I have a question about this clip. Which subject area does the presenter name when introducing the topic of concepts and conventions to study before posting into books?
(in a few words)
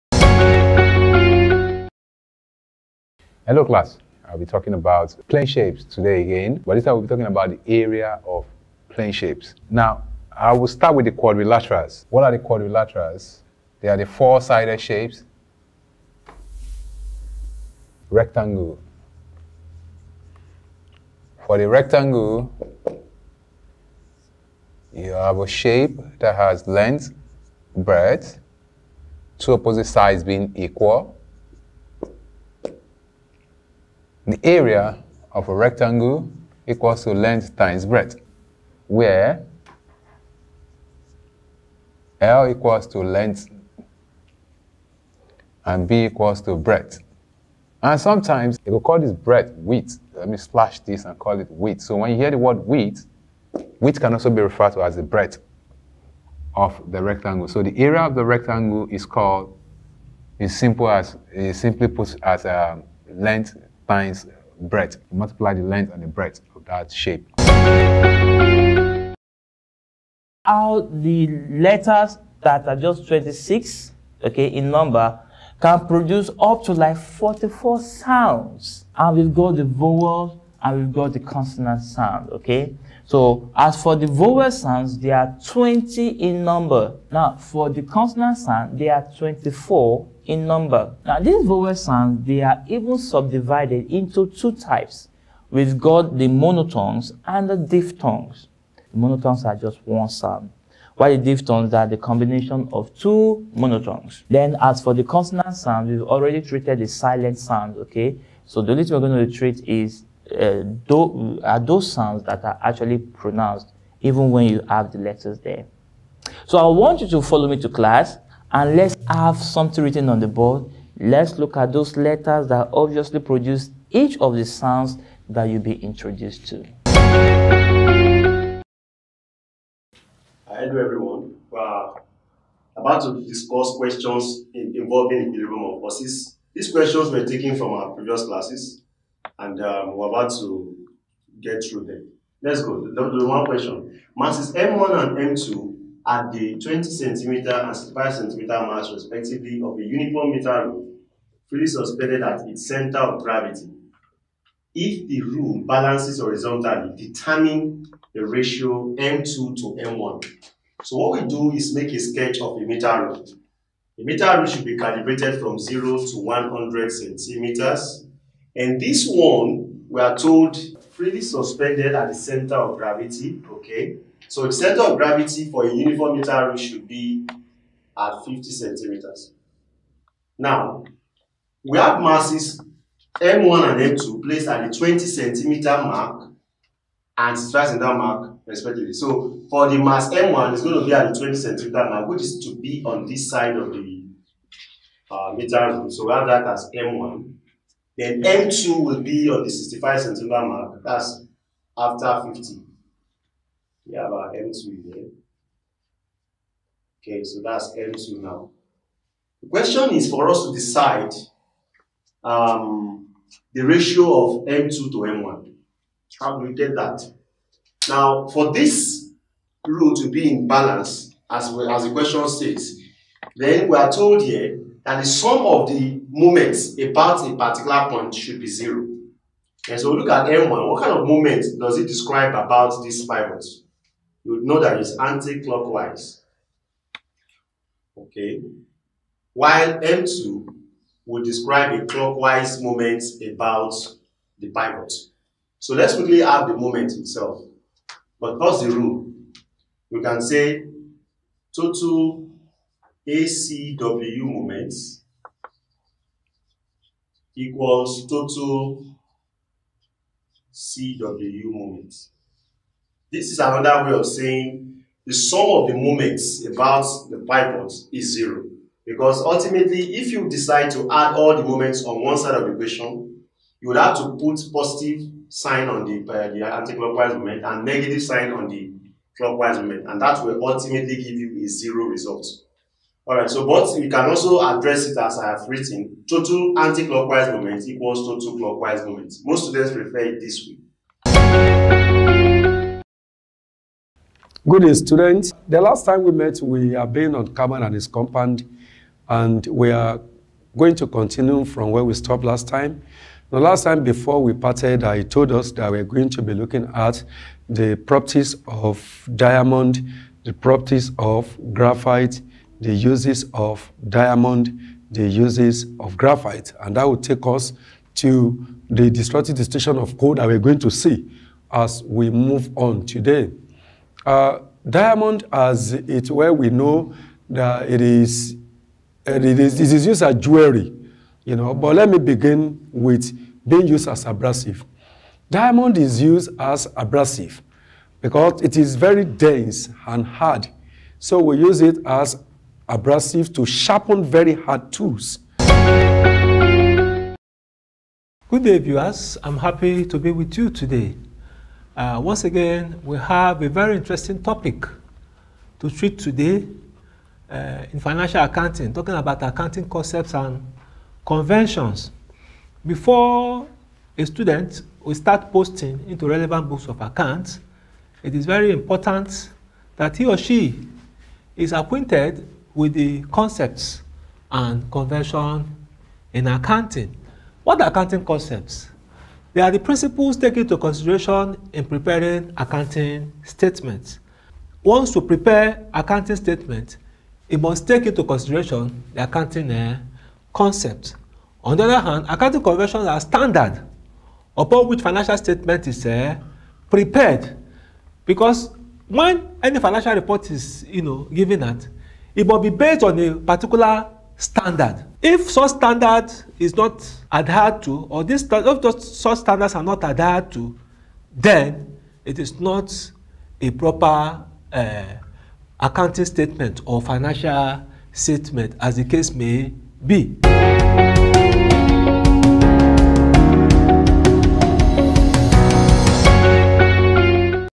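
financial accounting.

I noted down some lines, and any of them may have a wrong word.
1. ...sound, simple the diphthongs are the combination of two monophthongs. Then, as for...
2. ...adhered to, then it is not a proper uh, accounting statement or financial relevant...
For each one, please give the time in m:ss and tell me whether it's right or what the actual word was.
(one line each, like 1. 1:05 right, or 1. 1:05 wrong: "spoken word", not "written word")
1. 1:40 wrong: "while", not "simple"
2. 6:49 wrong: "statement", not "relevant".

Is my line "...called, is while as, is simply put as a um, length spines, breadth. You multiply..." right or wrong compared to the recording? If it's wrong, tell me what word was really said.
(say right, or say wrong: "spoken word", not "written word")
wrong: "simple", not "while".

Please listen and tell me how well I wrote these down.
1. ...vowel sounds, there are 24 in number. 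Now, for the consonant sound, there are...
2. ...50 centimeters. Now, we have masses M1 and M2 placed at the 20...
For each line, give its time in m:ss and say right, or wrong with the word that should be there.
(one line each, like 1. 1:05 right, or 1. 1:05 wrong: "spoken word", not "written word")
1. 1:24 wrong: "20", not "24"
2. 2:58 right.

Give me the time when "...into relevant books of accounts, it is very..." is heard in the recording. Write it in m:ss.
6:05.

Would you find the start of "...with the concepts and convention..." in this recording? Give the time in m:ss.
6:12.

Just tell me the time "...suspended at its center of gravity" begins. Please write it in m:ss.
2:31.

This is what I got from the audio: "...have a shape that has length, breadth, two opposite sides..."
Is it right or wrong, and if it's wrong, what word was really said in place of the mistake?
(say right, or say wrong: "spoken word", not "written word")
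right.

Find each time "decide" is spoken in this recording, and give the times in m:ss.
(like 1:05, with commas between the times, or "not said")
3:30, 4:30.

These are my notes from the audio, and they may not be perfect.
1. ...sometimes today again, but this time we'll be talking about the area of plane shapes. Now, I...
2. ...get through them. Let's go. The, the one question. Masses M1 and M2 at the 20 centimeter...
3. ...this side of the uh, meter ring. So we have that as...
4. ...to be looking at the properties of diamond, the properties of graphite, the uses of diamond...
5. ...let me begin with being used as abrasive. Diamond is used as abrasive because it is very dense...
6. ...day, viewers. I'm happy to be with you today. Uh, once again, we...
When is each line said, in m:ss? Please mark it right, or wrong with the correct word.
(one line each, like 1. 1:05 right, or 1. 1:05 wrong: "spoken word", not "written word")
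1. 0:05 wrong: "shapes", not "sometimes"
2. 2:21 right
3. 3:13 right
4. 5:06 right
5. 5:31 right
6. 5:48 right.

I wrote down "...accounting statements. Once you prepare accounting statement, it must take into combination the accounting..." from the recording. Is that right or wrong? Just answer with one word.
wrong.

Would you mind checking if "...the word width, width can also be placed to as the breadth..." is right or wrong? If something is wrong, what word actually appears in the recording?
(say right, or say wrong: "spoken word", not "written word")
wrong: "referred", not "placed".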